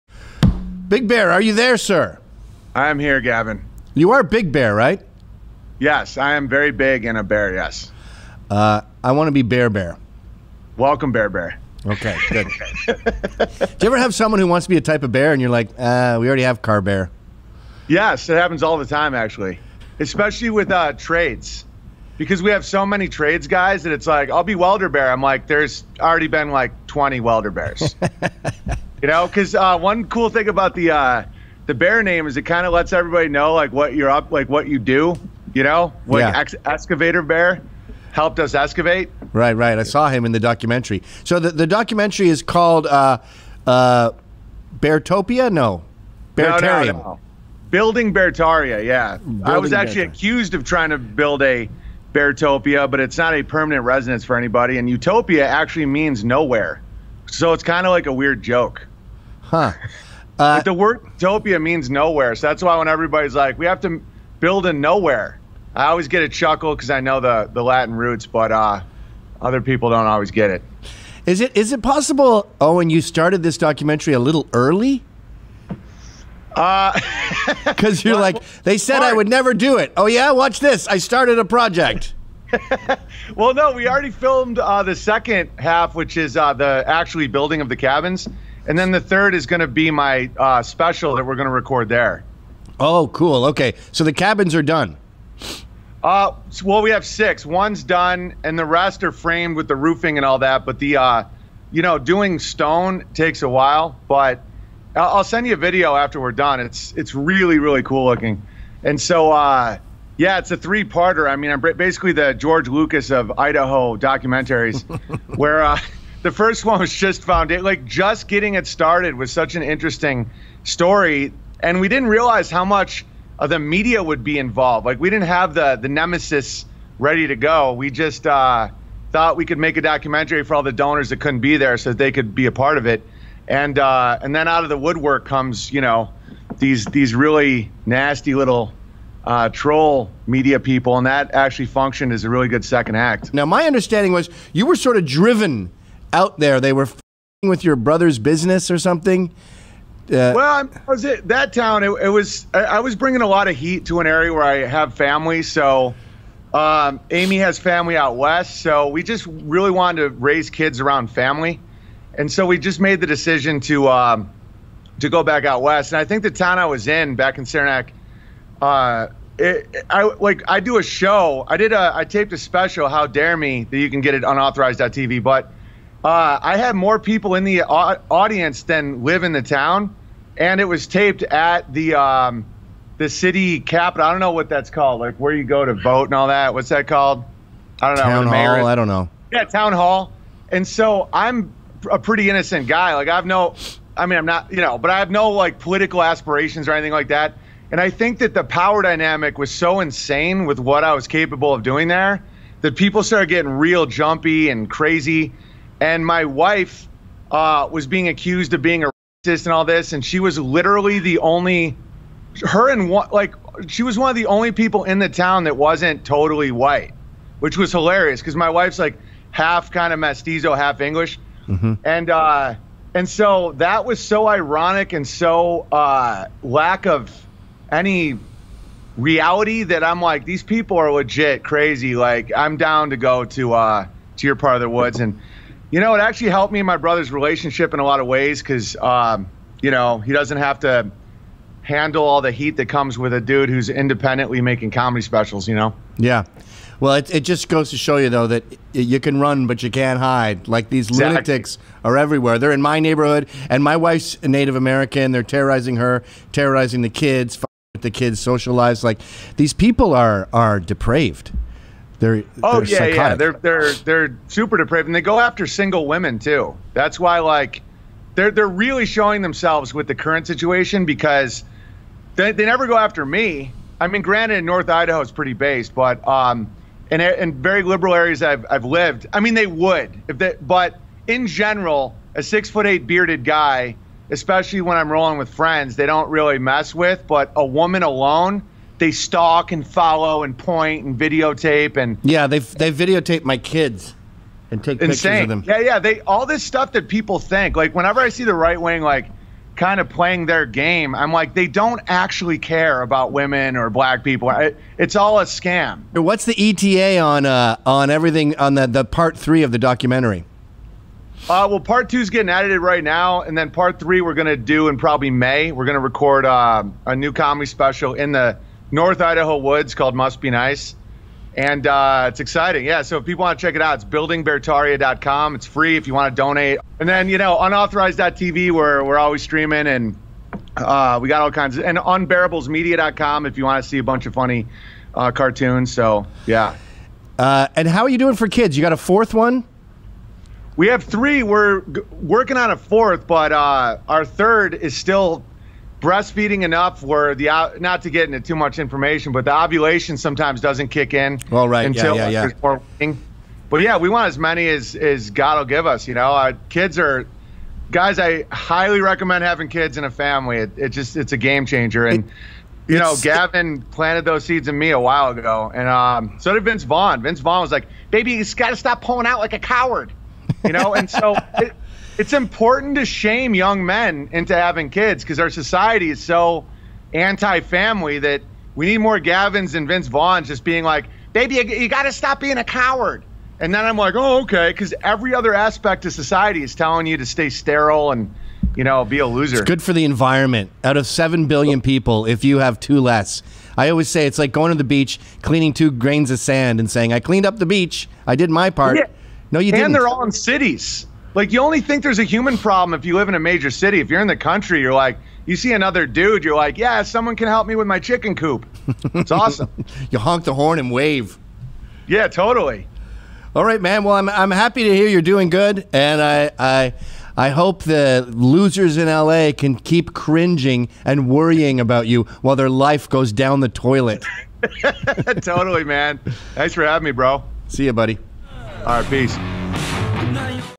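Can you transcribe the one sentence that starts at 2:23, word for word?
Now, my understanding was you were sort of driven out there.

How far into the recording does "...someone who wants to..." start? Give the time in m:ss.
0:14.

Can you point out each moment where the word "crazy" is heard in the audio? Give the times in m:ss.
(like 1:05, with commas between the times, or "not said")
3:24, 3:51.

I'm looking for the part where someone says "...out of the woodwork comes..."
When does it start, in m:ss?
2:14.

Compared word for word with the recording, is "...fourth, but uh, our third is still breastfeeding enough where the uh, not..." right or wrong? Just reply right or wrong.
right.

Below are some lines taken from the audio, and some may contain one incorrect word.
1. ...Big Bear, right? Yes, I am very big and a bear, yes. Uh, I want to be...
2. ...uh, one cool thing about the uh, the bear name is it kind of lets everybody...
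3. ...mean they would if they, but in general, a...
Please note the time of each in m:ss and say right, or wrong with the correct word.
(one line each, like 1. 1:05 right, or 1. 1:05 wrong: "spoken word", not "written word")
1. 0:04 right
2. 0:29 right
3. 4:39 right.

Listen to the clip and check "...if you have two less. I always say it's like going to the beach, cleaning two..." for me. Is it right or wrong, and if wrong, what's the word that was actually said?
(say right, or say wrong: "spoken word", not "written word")
right.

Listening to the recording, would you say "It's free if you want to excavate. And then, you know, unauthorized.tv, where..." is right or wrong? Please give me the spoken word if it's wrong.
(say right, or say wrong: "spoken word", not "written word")
wrong: "donate", not "excavate".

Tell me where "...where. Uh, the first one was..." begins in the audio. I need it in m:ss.
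1:55.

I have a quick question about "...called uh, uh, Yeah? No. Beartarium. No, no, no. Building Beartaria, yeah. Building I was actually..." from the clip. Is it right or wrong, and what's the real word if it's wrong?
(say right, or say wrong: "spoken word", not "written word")
wrong: "Beartopia", not "Yeah".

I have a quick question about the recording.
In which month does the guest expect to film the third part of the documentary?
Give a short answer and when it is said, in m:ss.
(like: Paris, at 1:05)
May, at 5:15.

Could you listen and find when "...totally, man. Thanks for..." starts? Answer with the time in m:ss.
7:05.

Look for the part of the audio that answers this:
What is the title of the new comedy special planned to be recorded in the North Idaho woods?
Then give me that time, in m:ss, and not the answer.
5:19.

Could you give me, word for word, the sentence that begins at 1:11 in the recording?
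Is it is it possible, Owen, you started this documentary a little early?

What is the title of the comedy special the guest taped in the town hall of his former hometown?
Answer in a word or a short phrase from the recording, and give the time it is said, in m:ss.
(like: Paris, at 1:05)
How Dare Me, at 2:52.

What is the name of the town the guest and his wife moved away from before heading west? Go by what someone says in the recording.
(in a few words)
Saranac.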